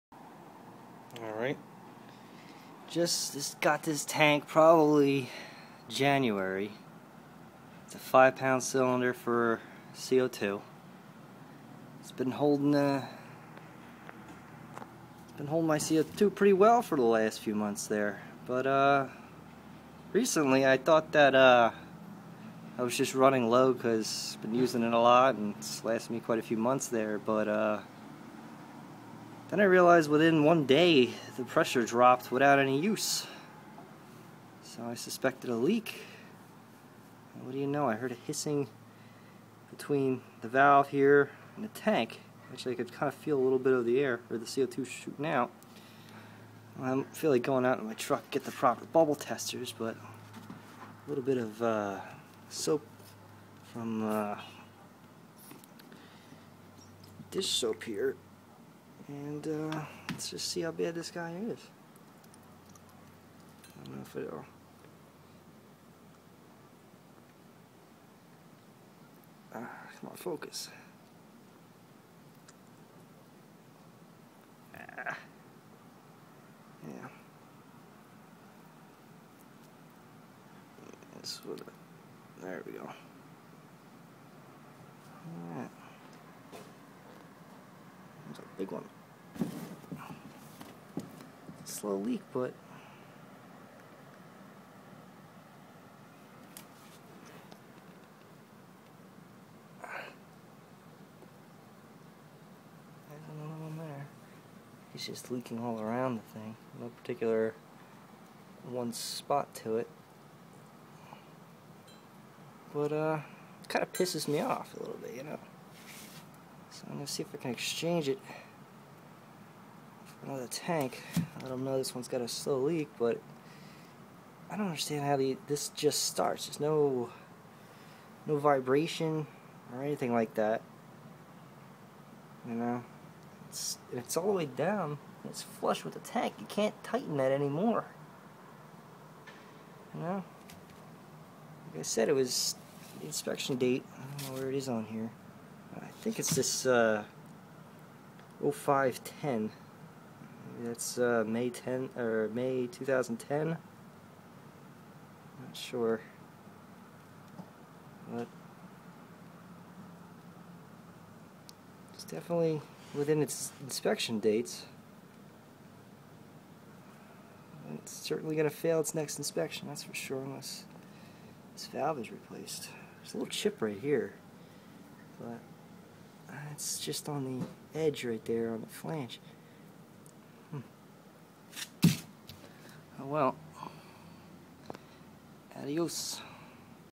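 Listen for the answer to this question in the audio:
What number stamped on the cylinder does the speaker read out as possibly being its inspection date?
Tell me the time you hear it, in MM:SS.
02:28.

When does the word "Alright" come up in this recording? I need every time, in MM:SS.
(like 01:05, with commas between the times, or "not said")
00:01, 01:25.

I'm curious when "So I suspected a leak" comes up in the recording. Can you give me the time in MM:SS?
00:34.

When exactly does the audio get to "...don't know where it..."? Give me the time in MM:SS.
02:24.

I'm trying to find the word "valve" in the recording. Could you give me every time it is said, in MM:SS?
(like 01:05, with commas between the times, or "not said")
00:40, 02:51.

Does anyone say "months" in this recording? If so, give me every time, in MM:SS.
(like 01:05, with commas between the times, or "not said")
00:17, 00:26.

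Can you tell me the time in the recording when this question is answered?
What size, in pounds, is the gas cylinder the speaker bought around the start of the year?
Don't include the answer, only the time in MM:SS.
00:07.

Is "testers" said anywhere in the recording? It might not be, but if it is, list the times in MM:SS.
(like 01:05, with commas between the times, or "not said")
00:49.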